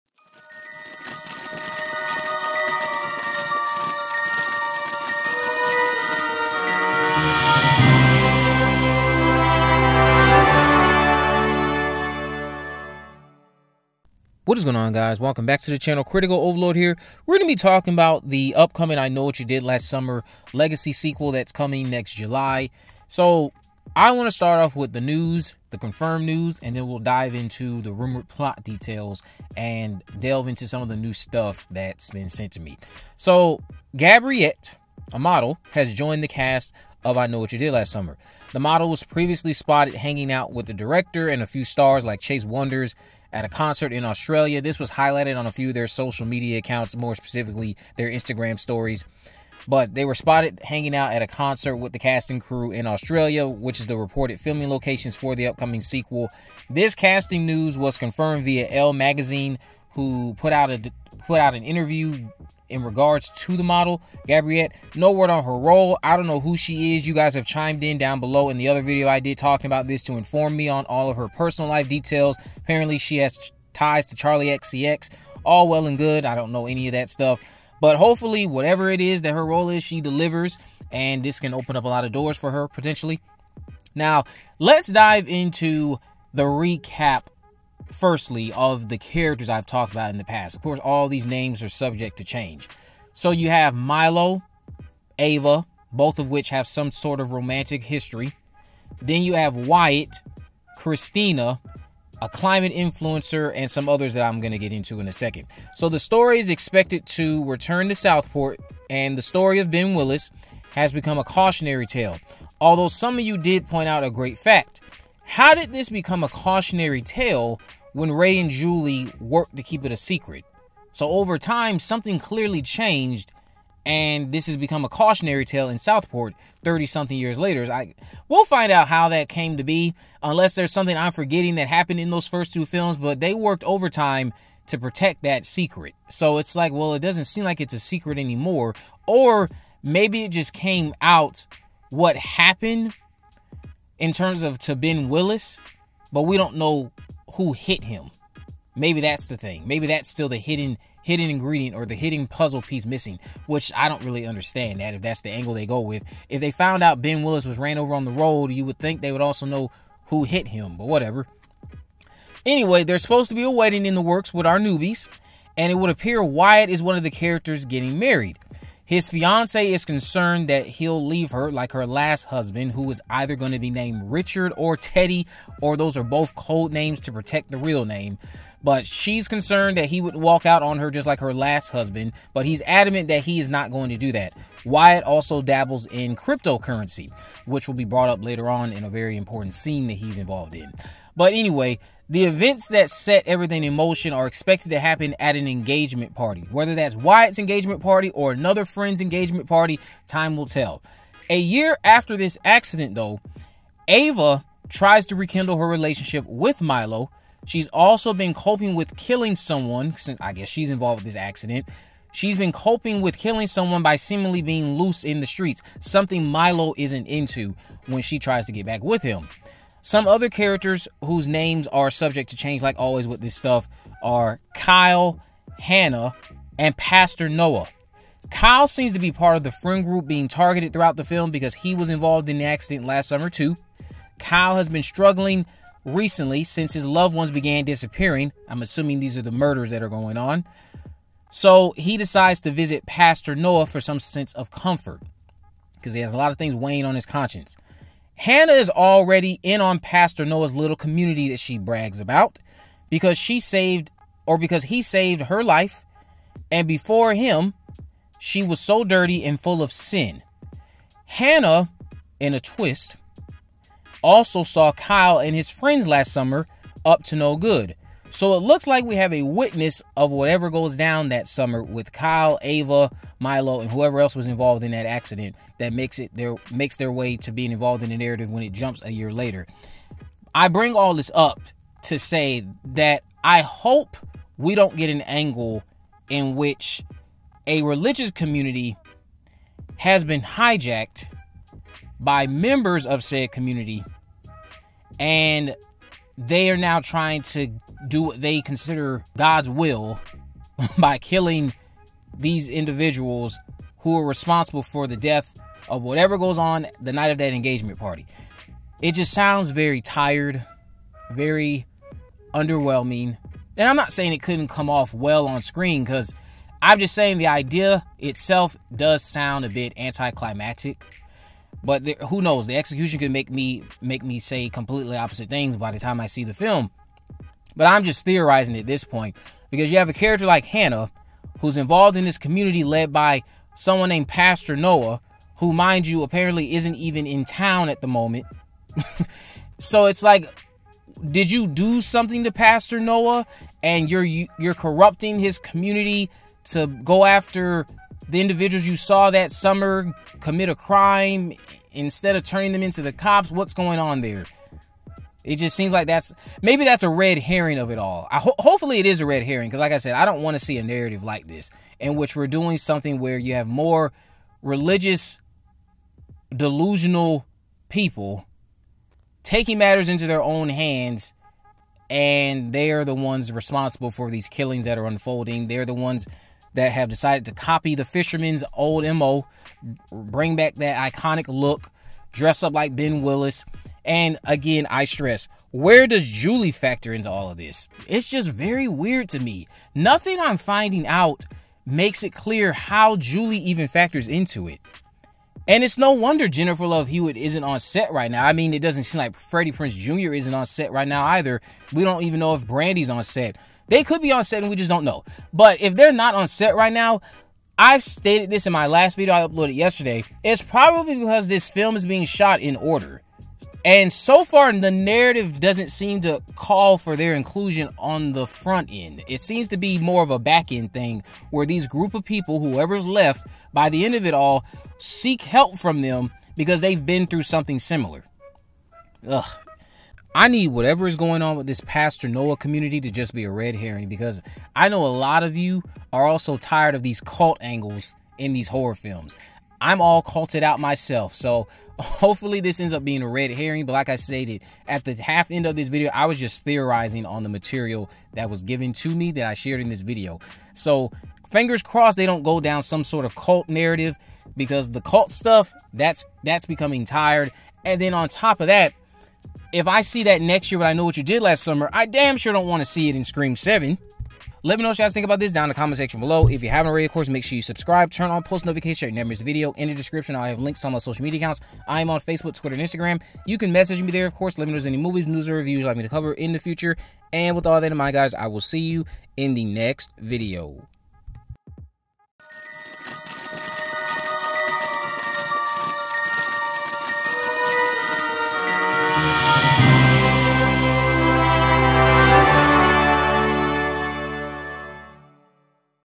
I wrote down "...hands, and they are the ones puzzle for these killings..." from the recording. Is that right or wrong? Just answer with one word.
wrong.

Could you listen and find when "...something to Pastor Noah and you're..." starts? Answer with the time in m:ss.
5:41.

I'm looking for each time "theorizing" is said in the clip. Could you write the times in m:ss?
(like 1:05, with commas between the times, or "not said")
5:28, 7:26.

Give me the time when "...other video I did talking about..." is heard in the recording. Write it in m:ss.
1:08.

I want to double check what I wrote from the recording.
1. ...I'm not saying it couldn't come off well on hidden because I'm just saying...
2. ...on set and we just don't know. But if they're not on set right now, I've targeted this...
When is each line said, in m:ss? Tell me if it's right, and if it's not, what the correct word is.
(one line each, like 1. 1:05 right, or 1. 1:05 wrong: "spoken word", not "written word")
1. 5:13 wrong: "screen", not "hidden"
2. 6:44 wrong: "stated", not "targeted".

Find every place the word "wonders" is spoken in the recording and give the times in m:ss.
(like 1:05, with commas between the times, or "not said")
0:42, 6:35.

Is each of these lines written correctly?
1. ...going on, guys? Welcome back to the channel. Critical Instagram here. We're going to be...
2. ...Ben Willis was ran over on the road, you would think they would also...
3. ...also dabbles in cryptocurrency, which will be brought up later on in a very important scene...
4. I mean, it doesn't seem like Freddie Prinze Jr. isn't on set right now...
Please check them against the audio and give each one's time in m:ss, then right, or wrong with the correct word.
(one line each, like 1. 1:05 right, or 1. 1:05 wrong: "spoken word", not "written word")
1. 0:14 wrong: "Overlord", not "Instagram"
2. 2:37 right
3. 3:05 right
4. 6:38 right.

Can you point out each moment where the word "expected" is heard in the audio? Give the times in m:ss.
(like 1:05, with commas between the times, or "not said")
1:46, 3:14.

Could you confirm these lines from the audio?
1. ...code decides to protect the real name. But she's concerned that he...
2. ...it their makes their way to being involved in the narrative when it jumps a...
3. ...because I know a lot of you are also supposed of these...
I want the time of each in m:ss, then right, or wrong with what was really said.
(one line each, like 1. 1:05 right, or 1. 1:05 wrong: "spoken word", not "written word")
1. 2:56 wrong: "names", not "decides"
2. 4:35 right
3. 7:13 wrong: "tired", not "supposed".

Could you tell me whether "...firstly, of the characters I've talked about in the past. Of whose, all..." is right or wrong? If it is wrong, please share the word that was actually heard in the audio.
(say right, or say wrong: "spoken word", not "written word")
wrong: "course", not "whose".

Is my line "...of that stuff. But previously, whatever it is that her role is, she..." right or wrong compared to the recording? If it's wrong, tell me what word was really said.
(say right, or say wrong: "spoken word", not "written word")
wrong: "hopefully", not "previously".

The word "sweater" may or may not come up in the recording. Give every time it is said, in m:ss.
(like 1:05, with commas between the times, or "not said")
not said.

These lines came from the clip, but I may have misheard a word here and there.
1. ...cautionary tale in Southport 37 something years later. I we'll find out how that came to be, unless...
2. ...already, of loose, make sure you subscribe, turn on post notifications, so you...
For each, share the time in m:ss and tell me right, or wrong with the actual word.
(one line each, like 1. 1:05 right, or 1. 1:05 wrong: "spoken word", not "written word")
1. 2:04 wrong: "30", not "37"
2. 7:46 wrong: "course", not "loose".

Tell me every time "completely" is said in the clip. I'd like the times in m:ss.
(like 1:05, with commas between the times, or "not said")
5:24.